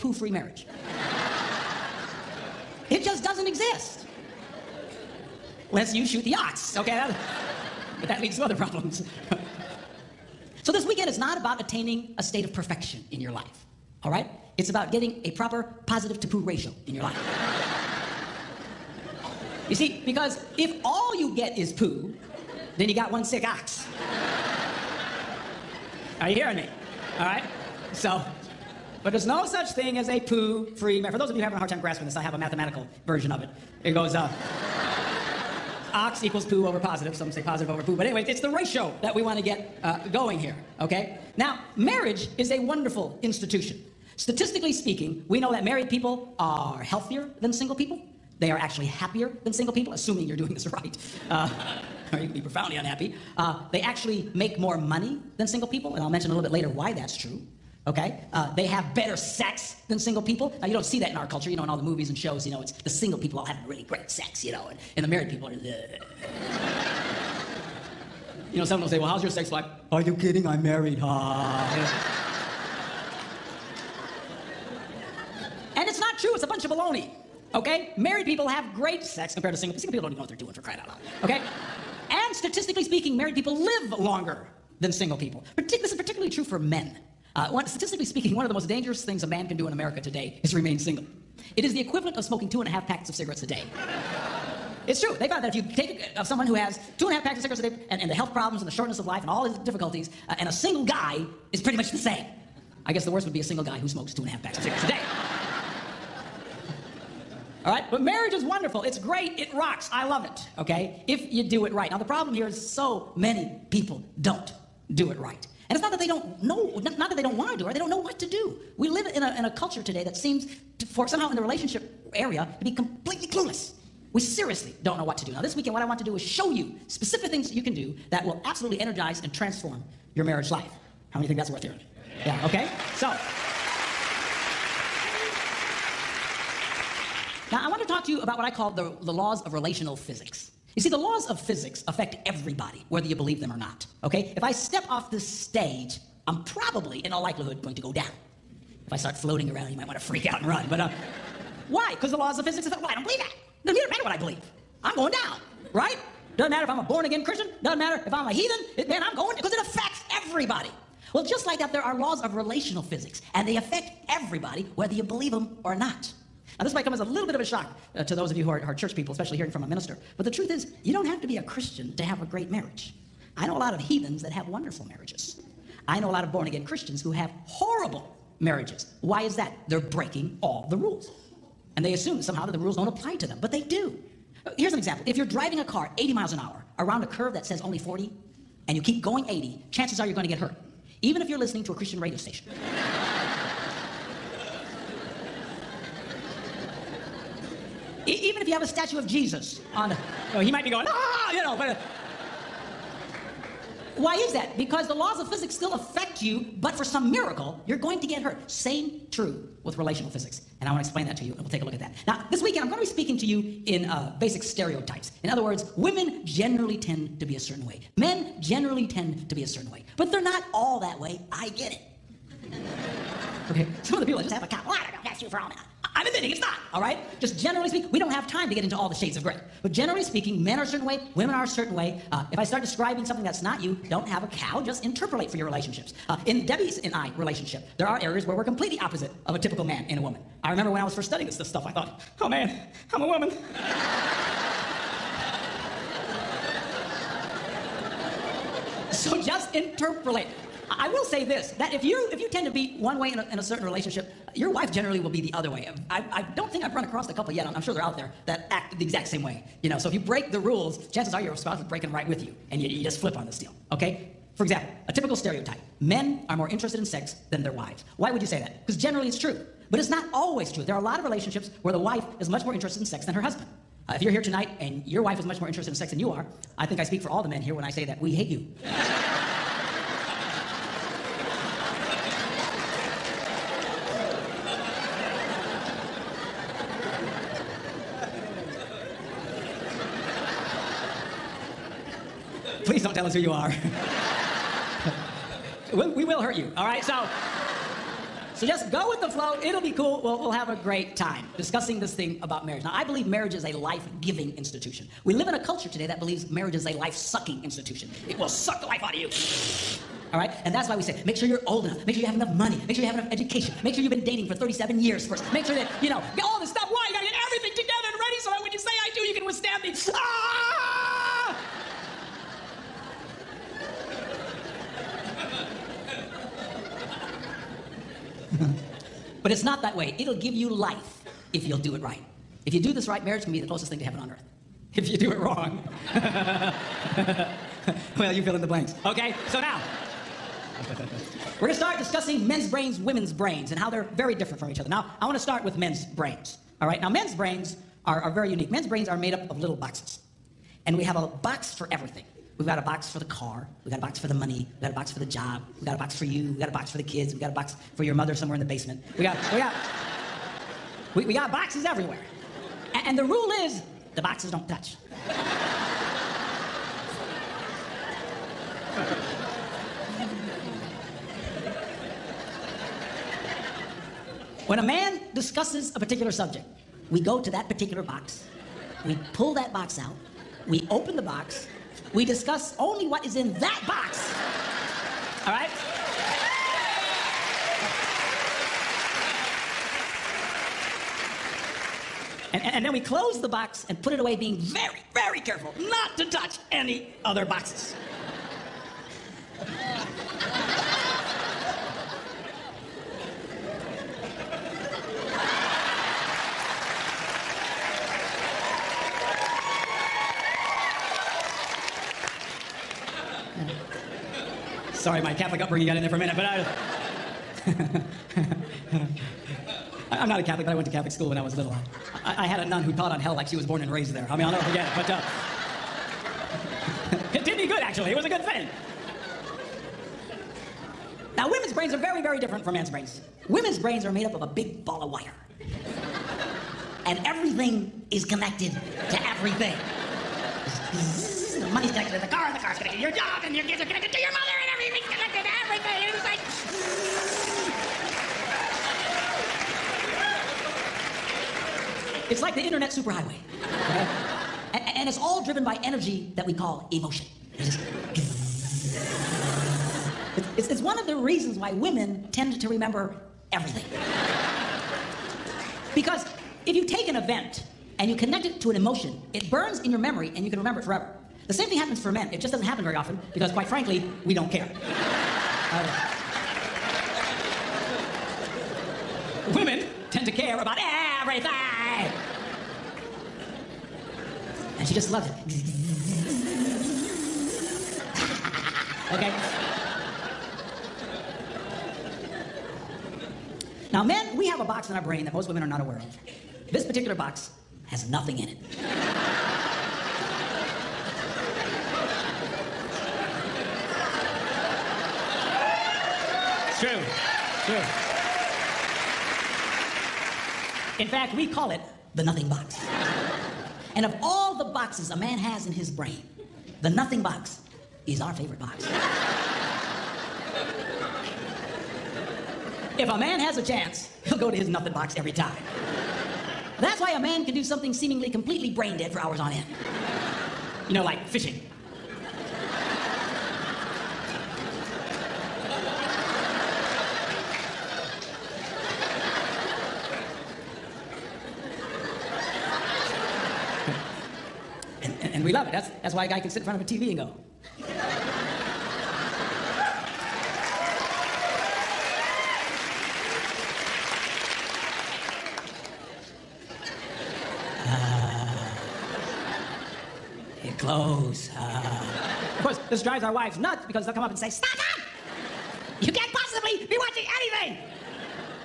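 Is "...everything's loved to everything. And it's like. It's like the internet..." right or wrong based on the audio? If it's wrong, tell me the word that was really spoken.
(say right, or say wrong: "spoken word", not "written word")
wrong: "connected", not "loved".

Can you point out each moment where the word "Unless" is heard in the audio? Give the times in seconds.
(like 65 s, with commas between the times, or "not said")
5 s.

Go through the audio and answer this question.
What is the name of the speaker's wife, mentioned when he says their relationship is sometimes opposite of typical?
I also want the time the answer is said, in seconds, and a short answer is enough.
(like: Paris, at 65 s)
Debbie, at 236 s.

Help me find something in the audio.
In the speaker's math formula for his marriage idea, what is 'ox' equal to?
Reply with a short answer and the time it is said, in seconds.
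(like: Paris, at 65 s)
poo over positive, at 36 s.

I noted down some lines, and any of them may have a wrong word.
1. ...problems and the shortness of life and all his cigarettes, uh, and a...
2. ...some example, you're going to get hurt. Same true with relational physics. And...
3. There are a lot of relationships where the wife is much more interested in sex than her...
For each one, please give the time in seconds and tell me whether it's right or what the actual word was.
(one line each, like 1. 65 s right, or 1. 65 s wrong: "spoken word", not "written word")
1. 98 s wrong: "difficulties", not "cigarettes"
2. 206 s wrong: "miracle", not "example"
3. 270 s right.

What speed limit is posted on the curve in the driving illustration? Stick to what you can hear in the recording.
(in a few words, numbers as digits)
40.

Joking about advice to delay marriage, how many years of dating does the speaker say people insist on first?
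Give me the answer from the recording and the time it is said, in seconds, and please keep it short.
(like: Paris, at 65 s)
37, at 314 s.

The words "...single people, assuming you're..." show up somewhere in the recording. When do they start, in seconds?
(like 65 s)
49 s.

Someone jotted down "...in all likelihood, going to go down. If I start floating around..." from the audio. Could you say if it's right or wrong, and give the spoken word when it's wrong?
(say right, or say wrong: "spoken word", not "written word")
right.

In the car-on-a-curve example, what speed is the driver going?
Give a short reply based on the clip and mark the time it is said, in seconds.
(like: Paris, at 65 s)
80 miles an hour, at 185 s.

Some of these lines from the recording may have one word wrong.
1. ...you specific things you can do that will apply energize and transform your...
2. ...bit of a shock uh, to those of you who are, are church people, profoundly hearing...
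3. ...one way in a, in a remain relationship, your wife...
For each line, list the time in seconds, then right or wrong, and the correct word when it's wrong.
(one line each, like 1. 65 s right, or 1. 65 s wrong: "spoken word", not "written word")
1. 126 s wrong: "absolutely", not "apply"
2. 167 s wrong: "especially", not "profoundly"
3. 252 s wrong: "certain", not "remain".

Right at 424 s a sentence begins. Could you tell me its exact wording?
I mean, I'll never forget it.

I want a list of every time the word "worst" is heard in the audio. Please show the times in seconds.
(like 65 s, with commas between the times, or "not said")
103 s.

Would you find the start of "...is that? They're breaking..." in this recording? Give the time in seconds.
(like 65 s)
179 s.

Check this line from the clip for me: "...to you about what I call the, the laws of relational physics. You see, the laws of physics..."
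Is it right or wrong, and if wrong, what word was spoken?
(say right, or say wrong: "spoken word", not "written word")
right.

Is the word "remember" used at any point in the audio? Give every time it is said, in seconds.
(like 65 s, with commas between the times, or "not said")
240 s, 462 s, 470 s.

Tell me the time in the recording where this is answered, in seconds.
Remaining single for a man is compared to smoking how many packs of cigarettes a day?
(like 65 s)
92 s.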